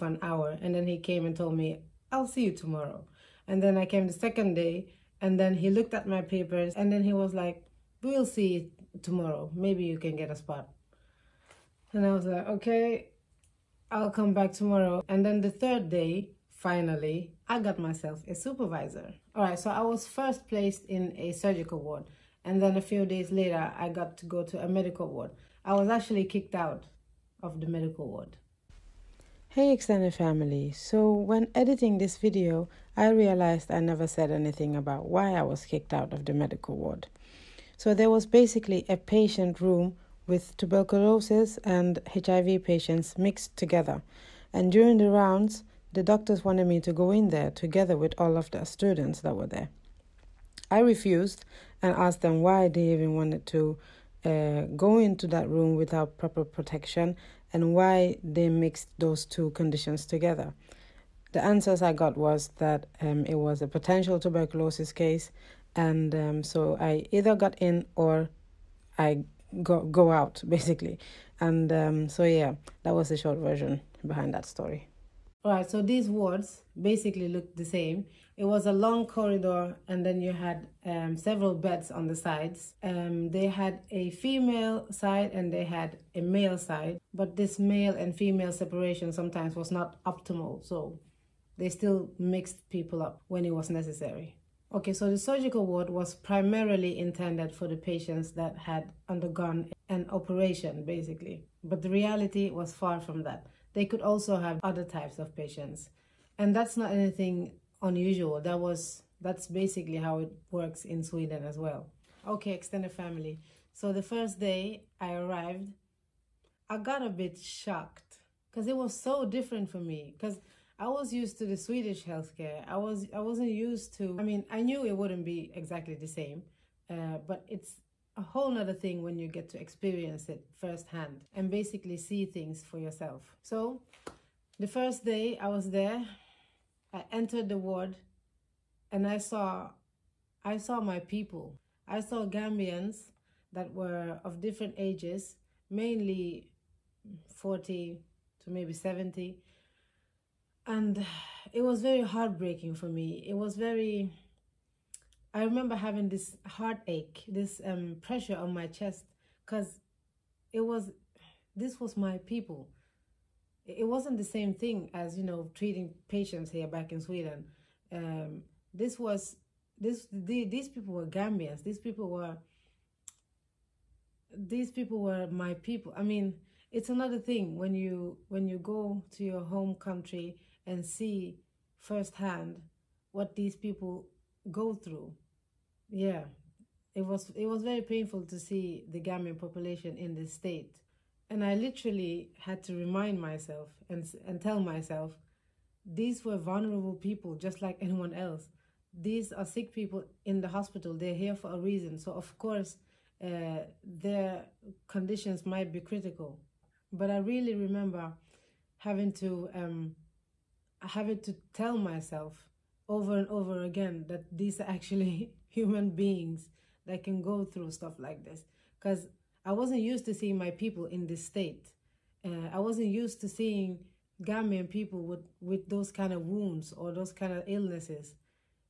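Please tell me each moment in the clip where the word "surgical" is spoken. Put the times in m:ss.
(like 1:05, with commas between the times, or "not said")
0:21, 1:35.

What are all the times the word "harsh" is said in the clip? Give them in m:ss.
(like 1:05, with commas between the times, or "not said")
not said.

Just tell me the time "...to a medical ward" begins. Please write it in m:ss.
0:24.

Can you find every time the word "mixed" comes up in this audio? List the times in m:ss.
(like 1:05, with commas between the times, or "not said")
0:43, 0:58, 1:32.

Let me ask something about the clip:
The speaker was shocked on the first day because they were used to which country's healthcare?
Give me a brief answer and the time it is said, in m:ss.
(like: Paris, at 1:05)
Swedish, at 2:01.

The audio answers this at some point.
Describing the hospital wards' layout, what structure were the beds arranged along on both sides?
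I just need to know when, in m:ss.
1:18.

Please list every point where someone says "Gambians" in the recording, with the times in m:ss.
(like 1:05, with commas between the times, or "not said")
2:22, 2:51, 3:08, 3:44.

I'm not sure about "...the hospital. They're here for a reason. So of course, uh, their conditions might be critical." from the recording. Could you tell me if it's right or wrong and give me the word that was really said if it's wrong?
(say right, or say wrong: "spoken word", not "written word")
right.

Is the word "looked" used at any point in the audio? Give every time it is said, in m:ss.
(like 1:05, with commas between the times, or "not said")
0:05, 1:17.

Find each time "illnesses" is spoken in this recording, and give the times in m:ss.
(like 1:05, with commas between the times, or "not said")
3:47.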